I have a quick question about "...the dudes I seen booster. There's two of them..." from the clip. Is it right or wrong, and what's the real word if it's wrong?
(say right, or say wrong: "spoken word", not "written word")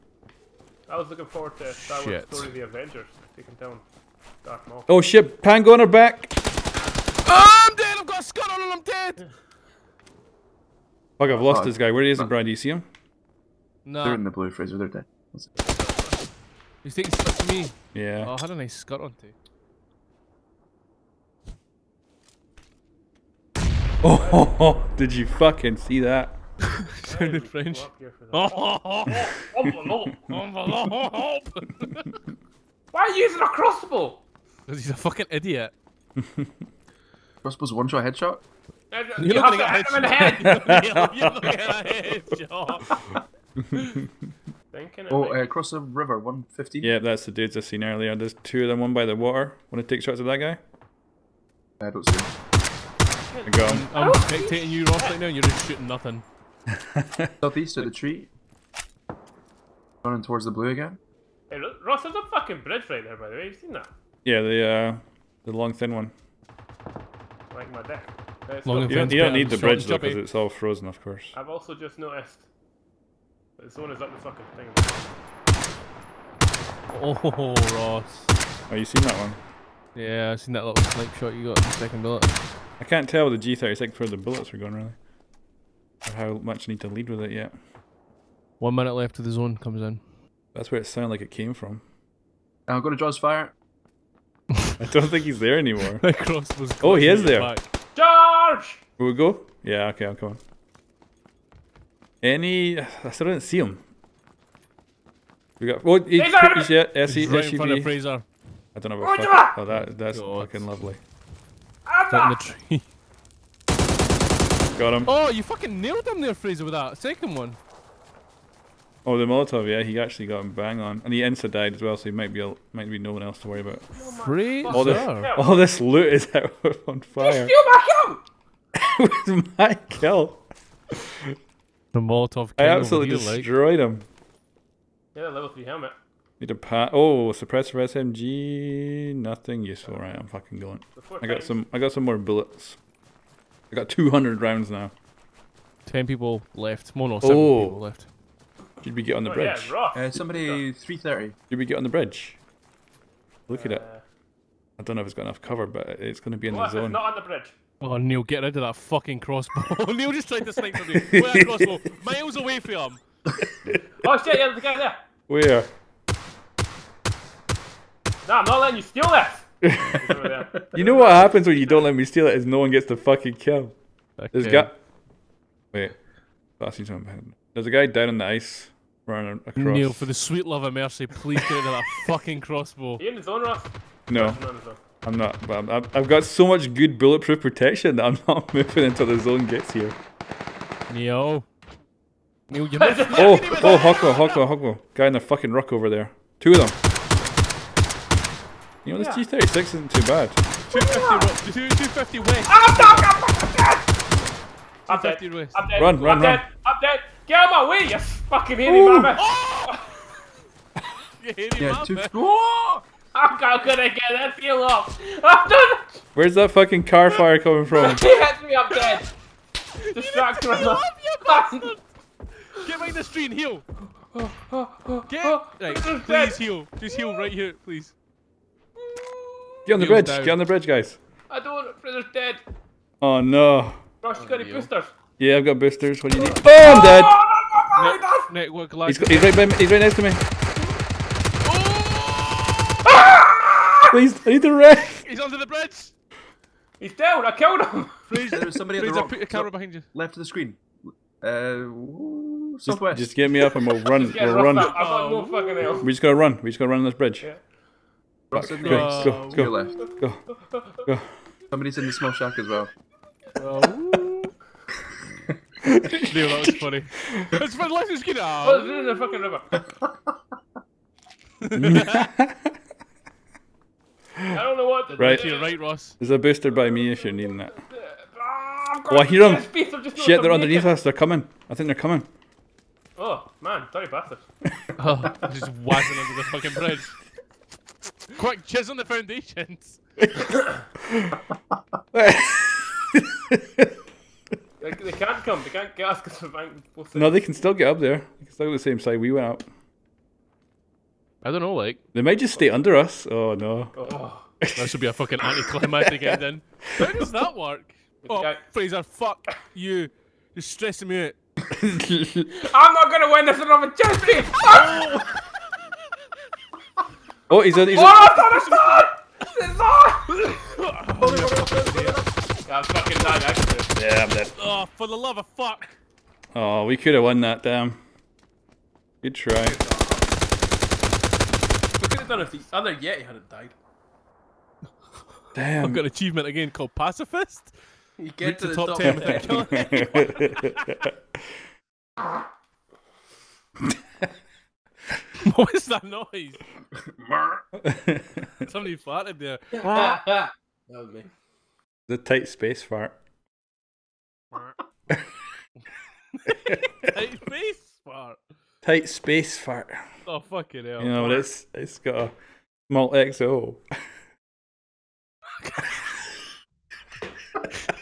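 wrong: "earlier", not "booster".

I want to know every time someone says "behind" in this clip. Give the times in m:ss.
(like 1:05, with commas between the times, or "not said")
3:42, 4:09.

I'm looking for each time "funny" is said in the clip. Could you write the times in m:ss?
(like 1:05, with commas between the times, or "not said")
4:26.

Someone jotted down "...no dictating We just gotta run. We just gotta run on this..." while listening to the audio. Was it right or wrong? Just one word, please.
wrong.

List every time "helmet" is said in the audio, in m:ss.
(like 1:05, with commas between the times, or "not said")
2:15.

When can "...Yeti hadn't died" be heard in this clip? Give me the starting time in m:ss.
5:32.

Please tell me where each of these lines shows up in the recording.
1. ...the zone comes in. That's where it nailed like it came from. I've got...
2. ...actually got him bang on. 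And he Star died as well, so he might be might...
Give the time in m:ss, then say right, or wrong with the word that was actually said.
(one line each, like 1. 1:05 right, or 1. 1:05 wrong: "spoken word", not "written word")
1. 1:29 wrong: "sounded", not "nailed"
2. 1:59 wrong: "Ensa", not "Star".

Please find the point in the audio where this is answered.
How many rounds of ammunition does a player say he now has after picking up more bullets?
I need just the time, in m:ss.
2:23.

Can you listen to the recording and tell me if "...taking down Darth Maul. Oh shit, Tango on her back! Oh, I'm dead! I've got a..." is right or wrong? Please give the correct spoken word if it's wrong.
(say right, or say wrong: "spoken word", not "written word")
right.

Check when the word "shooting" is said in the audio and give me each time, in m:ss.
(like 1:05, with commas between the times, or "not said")
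0:55.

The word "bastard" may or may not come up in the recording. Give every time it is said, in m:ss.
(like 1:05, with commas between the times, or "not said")
3:40, 4:43.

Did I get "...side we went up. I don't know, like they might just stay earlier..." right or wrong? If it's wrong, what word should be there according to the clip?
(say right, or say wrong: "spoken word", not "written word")
wrong: "under", not "earlier".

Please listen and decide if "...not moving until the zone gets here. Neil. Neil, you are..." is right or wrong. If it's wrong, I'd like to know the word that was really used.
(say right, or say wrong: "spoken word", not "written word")
right.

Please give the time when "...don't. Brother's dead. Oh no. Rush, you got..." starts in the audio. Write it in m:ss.
3:51.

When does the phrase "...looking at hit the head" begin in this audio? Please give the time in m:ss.
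0:39.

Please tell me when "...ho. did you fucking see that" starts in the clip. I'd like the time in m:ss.
0:24.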